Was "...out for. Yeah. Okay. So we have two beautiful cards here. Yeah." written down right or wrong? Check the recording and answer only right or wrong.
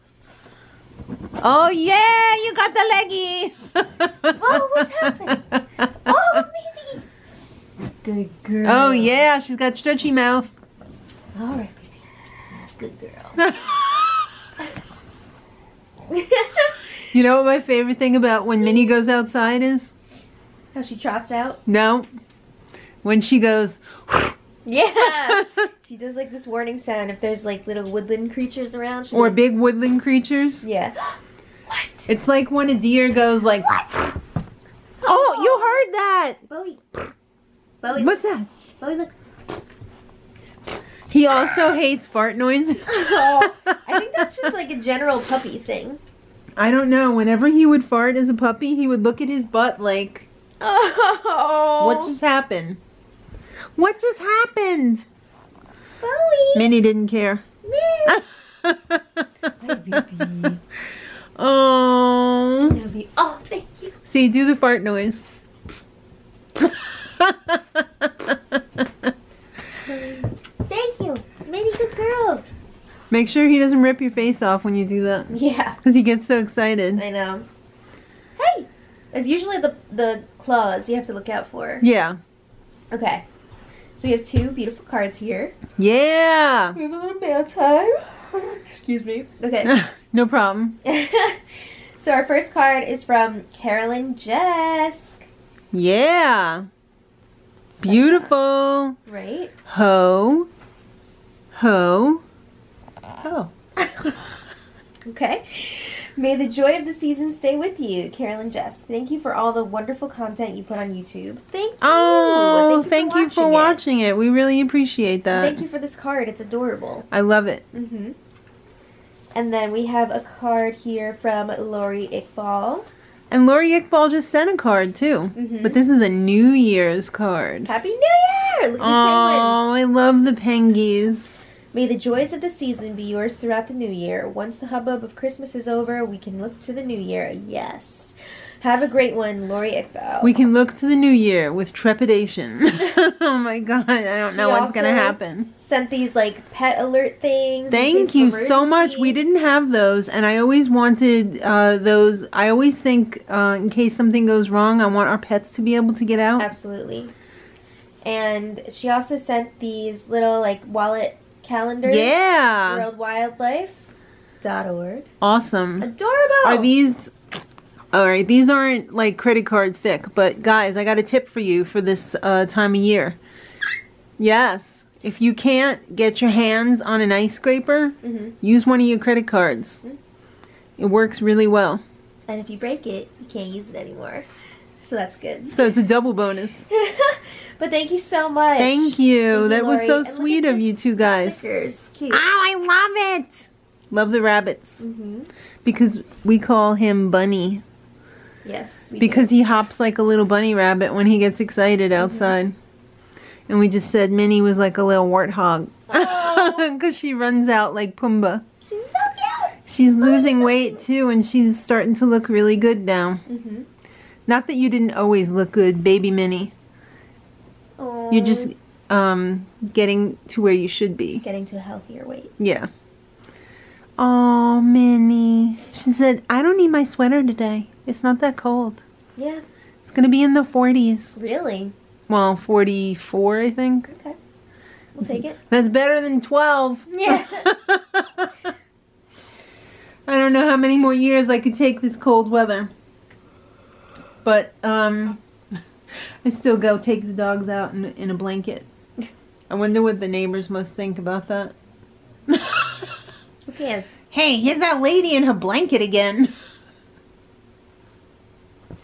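right.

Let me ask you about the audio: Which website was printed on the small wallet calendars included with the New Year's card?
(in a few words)
WorldWildlife.org.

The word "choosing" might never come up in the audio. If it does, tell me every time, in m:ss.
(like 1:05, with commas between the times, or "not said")
not said.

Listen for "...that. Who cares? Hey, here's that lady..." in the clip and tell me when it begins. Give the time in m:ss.
4:11.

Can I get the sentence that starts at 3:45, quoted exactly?
She said, I don't need my sweater today.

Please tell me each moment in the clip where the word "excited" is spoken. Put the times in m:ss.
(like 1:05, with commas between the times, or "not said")
1:16, 3:21.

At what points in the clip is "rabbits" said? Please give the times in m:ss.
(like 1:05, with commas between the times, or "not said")
3:14, 3:20.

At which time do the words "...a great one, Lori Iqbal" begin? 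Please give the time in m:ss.
2:18.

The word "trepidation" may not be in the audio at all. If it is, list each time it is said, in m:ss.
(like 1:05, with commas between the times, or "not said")
2:21.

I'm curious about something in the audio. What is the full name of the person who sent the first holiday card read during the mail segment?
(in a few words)
Carolyn Jesk.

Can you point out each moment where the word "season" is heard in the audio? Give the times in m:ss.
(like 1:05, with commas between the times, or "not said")
1:46, 2:12.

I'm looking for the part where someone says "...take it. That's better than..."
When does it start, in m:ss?
3:55.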